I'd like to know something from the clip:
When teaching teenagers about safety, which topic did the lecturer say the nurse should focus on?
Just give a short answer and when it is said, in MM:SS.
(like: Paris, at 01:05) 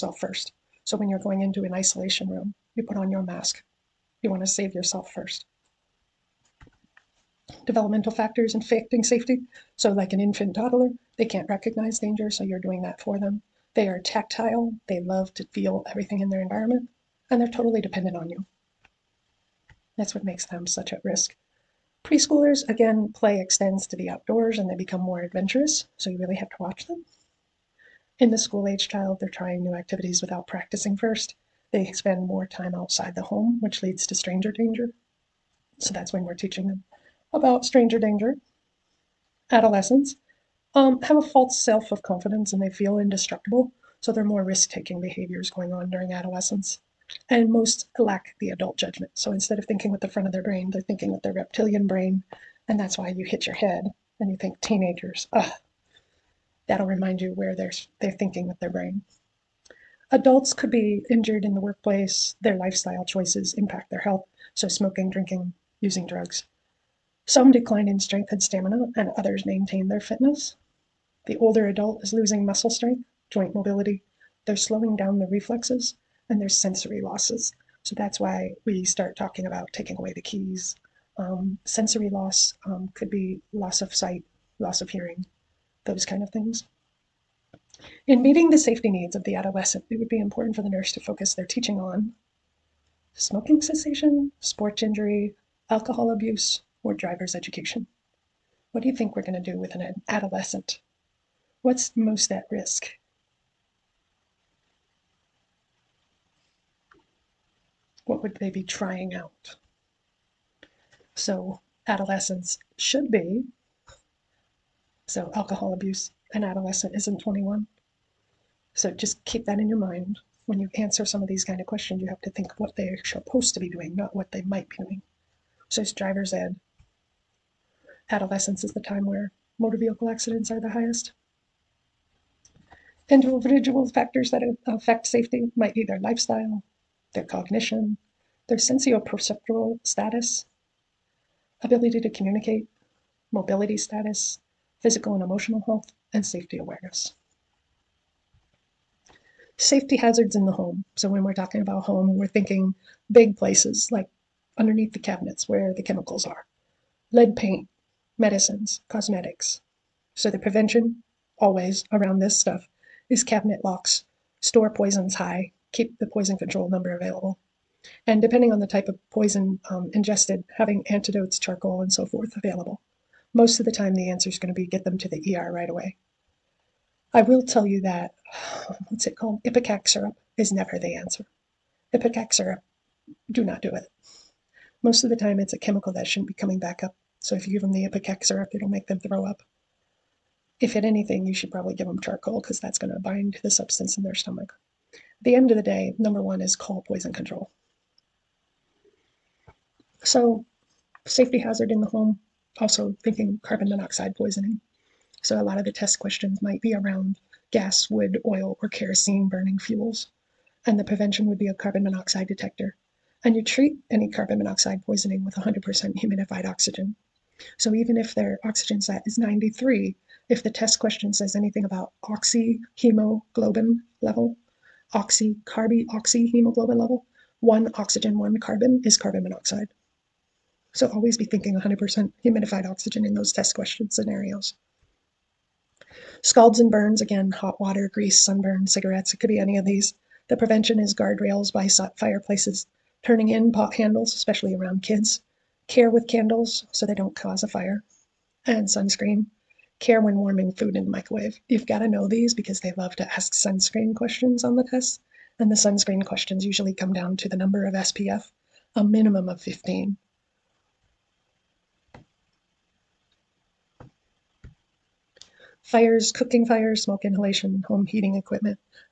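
Driver's education, at 02:05.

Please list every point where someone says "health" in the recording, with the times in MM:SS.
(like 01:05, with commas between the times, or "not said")
01:04, 02:25.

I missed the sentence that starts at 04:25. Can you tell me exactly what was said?
Fires, cooking fires, smoke inhalation, home heating equipment.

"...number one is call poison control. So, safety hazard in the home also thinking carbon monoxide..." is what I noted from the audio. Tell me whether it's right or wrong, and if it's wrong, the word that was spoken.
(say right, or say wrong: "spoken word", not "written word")
right.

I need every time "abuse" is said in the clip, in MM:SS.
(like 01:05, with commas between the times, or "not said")
01:36, 01:55.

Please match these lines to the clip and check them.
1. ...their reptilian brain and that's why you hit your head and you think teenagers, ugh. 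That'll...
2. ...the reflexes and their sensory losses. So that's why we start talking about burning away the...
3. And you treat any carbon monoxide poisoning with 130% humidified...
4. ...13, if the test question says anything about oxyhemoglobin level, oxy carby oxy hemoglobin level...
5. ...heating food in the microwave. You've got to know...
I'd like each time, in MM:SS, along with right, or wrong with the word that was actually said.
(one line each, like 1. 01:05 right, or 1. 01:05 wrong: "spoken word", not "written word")
1. 00:51 right
2. 01:15 wrong: "taking", not "burning"
3. 03:33 wrong: "100", not "130"
4. 03:39 wrong: "93", not "13"
5. 04:10 wrong: "warming", not "heating".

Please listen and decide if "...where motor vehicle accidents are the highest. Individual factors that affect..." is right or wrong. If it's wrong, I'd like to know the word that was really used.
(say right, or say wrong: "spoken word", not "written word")
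right.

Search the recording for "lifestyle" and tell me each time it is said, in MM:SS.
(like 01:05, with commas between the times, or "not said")
01:02, 02:15.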